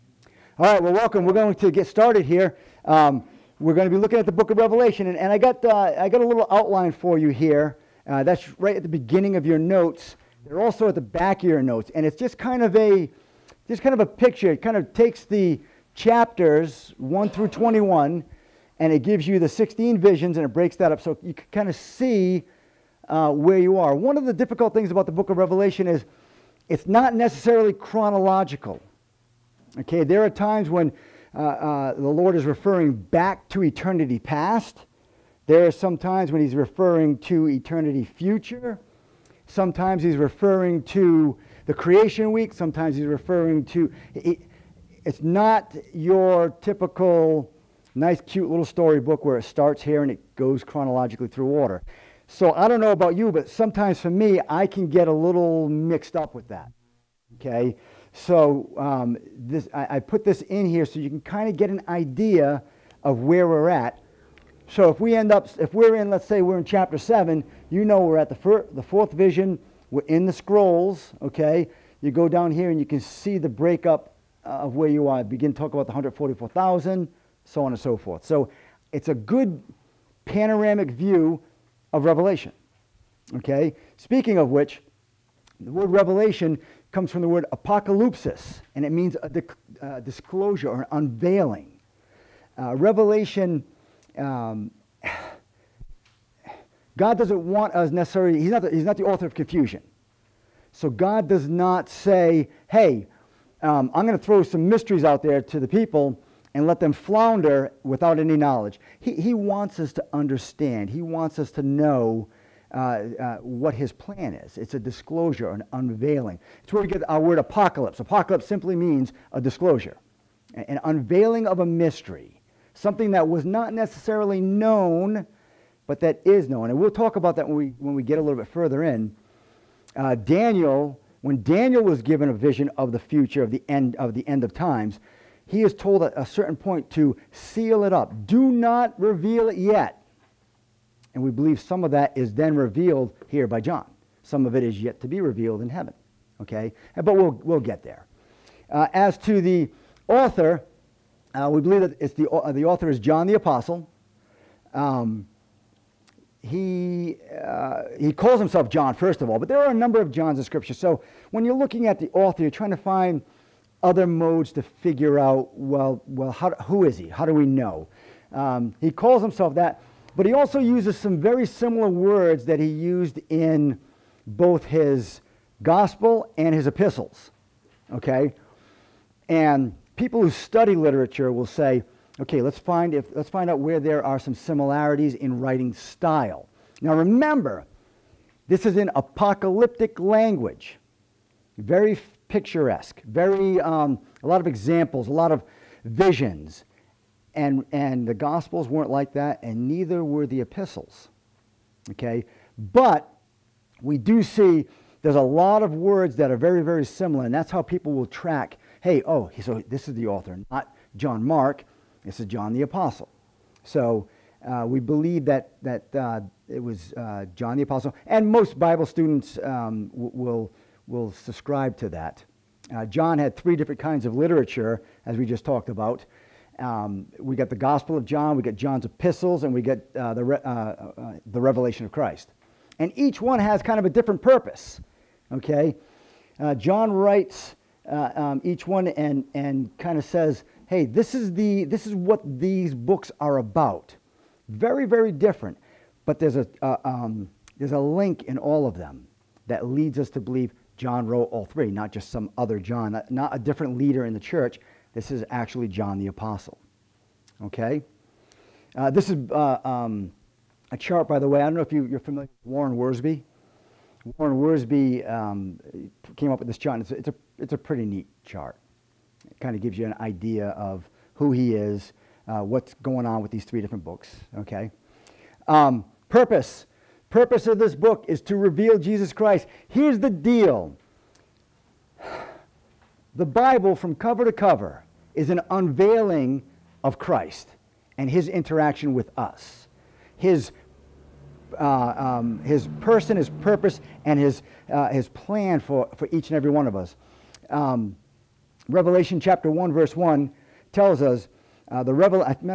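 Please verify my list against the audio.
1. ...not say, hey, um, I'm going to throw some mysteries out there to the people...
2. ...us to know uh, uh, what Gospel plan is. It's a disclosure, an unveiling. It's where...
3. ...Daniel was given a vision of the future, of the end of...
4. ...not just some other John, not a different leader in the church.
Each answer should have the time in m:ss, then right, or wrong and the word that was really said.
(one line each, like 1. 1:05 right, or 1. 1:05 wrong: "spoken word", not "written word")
1. 1:41 right
2. 1:51 wrong: "His", not "Gospel"
3. 2:11 right
4. 4:11 right.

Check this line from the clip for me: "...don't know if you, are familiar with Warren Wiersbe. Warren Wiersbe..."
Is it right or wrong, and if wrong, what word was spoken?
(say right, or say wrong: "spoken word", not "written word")
right.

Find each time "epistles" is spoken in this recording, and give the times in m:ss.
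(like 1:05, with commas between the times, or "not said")
2:56, 3:20, 3:48.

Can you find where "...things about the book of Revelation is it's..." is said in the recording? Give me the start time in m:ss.
0:24.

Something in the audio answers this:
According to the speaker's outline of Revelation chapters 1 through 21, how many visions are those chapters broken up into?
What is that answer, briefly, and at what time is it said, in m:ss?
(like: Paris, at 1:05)
16, at 0:19.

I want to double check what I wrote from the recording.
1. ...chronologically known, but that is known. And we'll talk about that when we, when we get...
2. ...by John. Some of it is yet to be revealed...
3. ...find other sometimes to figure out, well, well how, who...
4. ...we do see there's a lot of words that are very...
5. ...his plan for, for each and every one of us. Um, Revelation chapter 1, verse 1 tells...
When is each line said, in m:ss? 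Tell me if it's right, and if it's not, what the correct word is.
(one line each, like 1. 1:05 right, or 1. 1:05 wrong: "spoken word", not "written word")
1. 2:03 wrong: "necessarily", not "chronologically"
2. 2:23 right
3. 2:42 wrong: "modes", not "sometimes"
4. 3:23 right
5. 4:54 right.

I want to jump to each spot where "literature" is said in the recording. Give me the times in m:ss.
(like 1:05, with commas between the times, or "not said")
3:00, 3:44.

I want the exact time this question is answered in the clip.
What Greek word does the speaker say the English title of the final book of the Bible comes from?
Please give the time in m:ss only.
1:27.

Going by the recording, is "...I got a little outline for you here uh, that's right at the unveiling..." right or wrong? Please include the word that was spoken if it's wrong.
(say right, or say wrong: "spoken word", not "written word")
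wrong: "beginning", not "unveiling".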